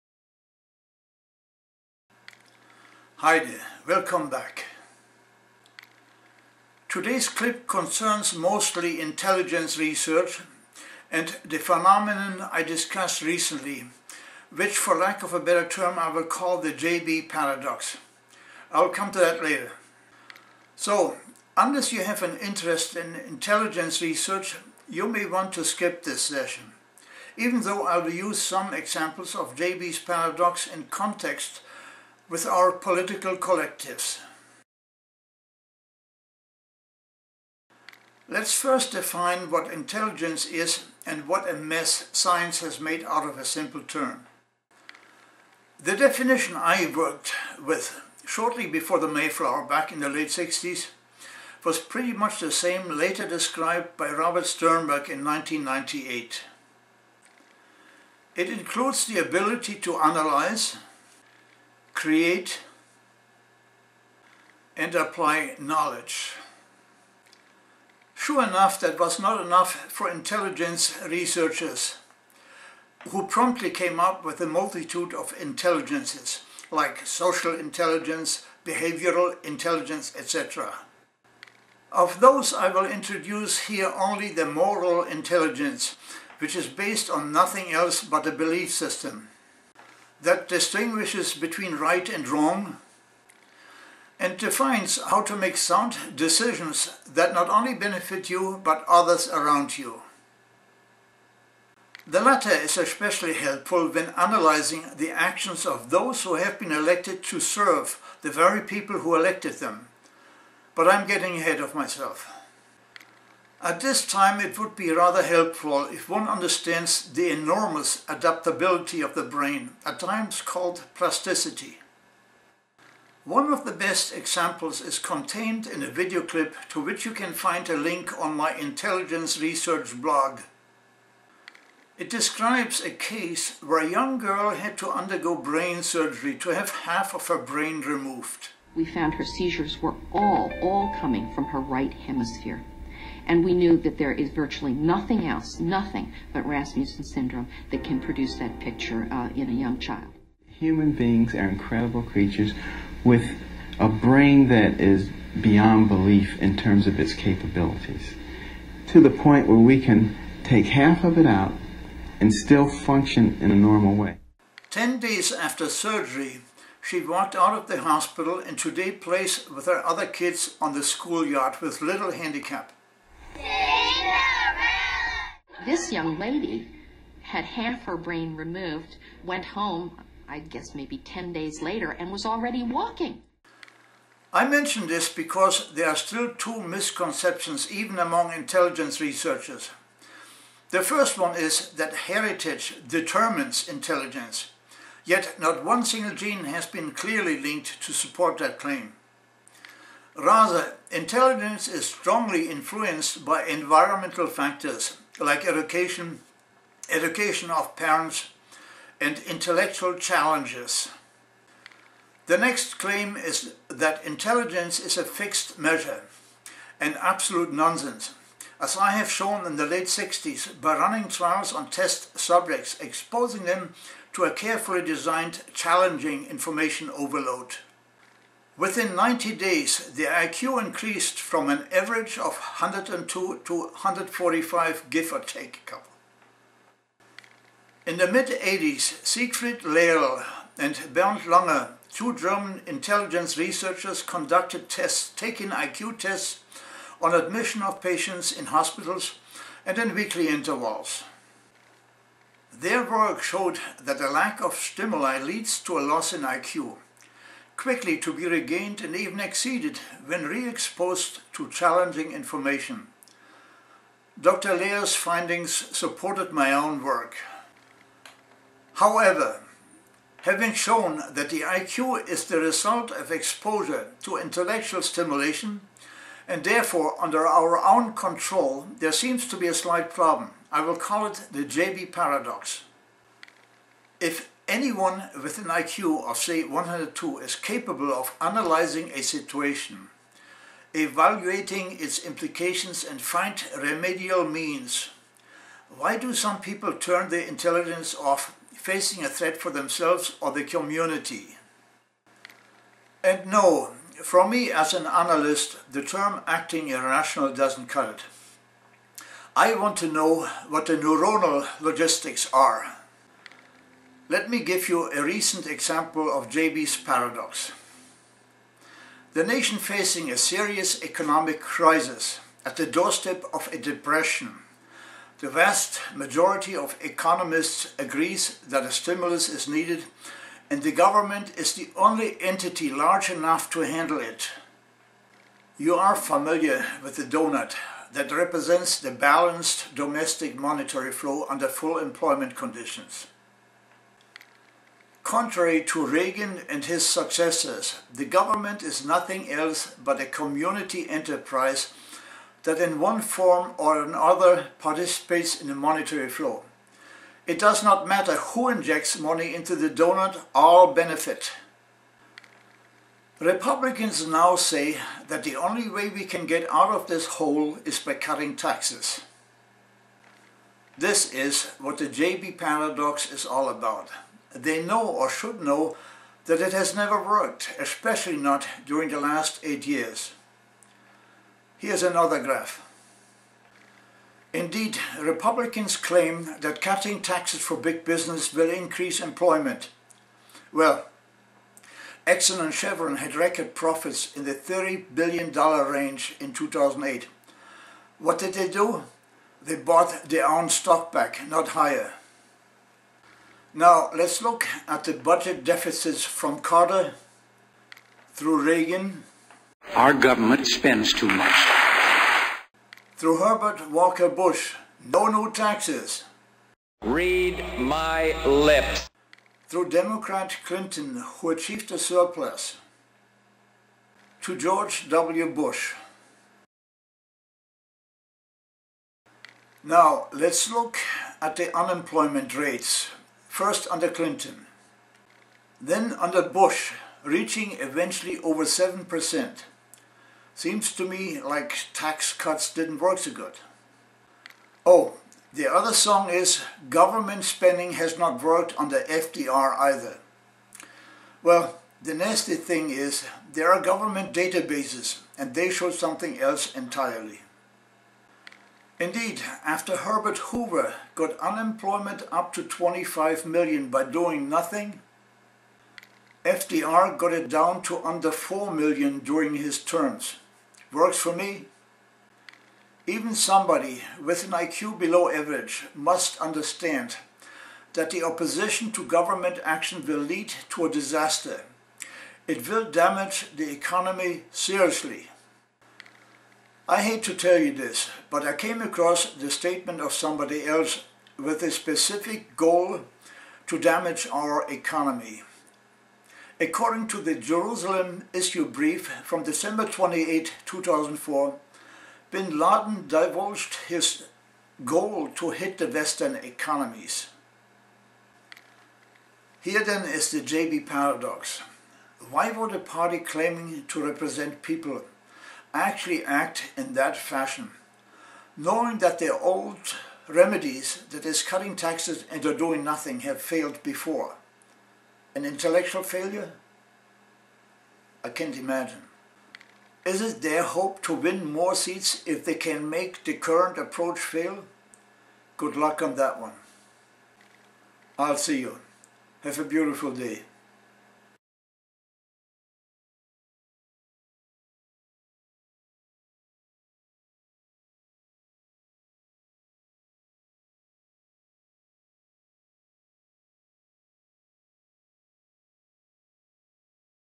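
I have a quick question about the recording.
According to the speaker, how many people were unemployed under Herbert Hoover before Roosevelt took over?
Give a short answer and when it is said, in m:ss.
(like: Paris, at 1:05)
25 million, at 7:42.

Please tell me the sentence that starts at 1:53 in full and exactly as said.
At this time it would be rather helpful if one understands the enormous adaptability of the brain, at times called plasticity.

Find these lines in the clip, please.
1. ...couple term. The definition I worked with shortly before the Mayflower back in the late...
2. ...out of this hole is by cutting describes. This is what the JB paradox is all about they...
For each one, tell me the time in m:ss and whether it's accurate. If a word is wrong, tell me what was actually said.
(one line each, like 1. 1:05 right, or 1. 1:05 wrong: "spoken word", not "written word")
1. 0:43 wrong: "simple", not "couple"
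2. 6:06 wrong: "taxes", not "describes".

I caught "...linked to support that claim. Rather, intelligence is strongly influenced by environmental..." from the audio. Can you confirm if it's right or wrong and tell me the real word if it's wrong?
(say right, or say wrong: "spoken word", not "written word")
right.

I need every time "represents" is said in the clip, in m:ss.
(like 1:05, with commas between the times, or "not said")
5:38, 8:33.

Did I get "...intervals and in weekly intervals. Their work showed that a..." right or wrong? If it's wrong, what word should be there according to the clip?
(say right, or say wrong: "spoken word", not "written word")
wrong: "hospitals", not "intervals".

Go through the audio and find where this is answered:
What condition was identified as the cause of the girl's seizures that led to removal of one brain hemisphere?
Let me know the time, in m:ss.
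2:26.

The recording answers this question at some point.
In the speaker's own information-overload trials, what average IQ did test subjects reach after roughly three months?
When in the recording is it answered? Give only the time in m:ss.
3:53.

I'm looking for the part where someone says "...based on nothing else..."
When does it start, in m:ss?
1:26.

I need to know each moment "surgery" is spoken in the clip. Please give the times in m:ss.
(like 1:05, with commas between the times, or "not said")
2:15, 2:45.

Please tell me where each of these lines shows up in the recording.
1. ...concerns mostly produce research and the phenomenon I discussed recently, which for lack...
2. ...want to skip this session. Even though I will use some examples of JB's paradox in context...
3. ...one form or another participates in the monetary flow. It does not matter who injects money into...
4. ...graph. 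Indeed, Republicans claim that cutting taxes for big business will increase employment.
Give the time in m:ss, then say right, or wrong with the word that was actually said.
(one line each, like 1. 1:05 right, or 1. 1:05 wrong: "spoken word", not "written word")
1. 0:07 wrong: "intelligence", not "produce"
2. 0:25 right
3. 5:52 right
4. 6:22 right.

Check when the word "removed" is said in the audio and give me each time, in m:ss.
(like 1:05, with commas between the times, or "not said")
2:17, 2:58.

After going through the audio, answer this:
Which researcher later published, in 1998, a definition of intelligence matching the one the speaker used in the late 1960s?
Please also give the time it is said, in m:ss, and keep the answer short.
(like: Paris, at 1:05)
Robert Sternberg, at 0:54.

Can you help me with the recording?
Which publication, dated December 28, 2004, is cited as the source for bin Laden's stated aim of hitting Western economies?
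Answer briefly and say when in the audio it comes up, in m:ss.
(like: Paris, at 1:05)
Jerusalem Issue Brief, at 8:17.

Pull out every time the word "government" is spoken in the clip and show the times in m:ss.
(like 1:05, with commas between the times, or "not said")
5:30, 5:48, 6:49, 7:26, 7:33, 7:58.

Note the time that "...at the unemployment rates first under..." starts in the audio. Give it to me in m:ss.
7:11.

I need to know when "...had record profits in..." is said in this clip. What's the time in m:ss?
6:32.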